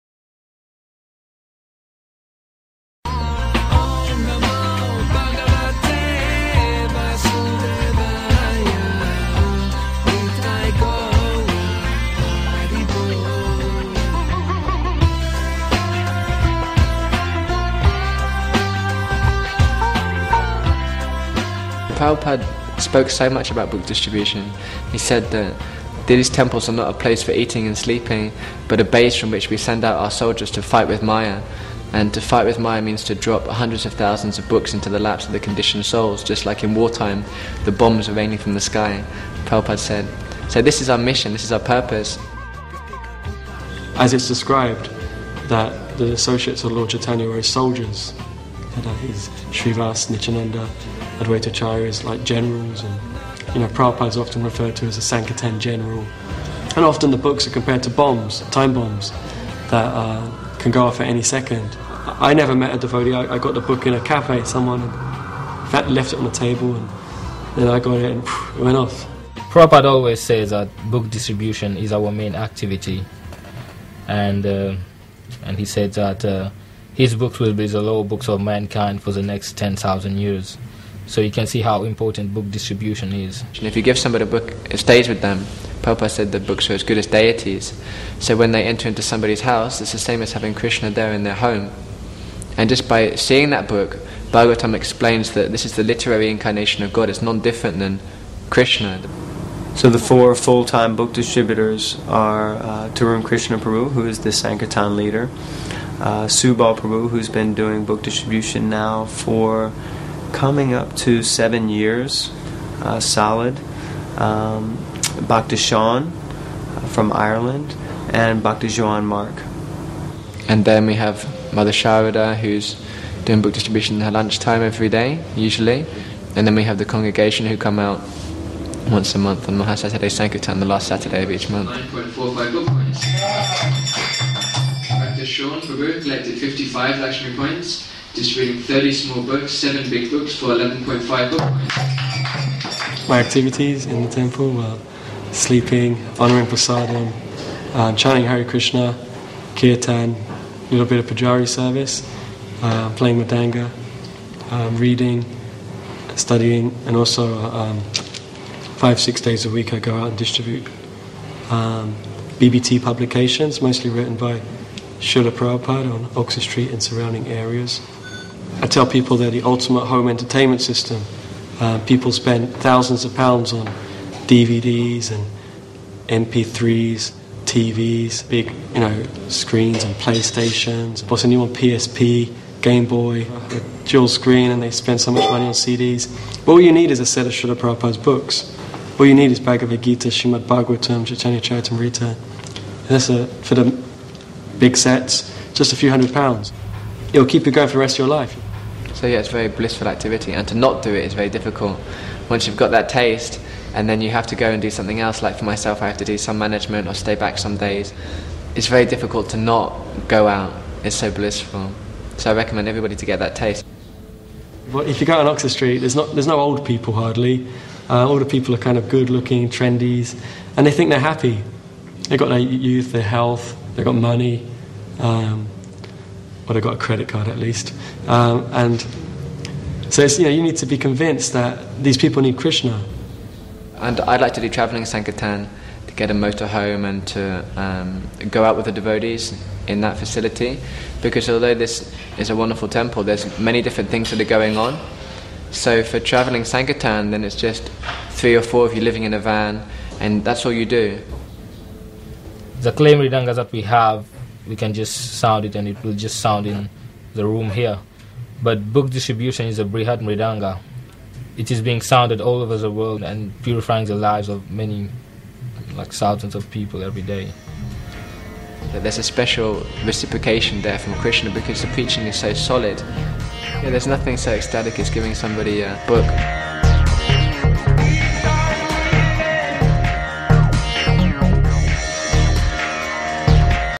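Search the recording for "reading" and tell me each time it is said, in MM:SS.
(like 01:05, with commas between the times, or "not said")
02:18, 02:34.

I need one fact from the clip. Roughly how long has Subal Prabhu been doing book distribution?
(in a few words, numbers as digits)
Nearly 7 years.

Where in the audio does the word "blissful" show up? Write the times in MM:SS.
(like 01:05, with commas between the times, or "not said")
03:19, 03:31.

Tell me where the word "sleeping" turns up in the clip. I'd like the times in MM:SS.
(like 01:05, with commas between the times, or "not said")
00:27, 02:25.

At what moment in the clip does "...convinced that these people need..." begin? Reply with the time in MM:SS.
03:50.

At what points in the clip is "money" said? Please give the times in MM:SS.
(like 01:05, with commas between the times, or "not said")
03:05, 03:43.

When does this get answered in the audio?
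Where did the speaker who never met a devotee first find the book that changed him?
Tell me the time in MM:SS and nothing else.
01:03.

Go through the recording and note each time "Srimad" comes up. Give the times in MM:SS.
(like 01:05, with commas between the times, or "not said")
03:10.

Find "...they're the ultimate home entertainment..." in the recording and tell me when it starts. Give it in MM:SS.
02:49.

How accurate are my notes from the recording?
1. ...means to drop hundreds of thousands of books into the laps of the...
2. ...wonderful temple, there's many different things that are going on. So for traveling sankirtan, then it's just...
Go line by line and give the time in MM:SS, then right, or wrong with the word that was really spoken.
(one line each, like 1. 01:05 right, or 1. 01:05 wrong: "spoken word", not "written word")
1. 00:32 right
2. 04:02 right.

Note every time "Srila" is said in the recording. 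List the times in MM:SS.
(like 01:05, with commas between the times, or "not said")
02:44, 03:07.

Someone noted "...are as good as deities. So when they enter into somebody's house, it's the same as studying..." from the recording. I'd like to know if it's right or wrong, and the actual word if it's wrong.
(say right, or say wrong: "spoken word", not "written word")
wrong: "having", not "studying".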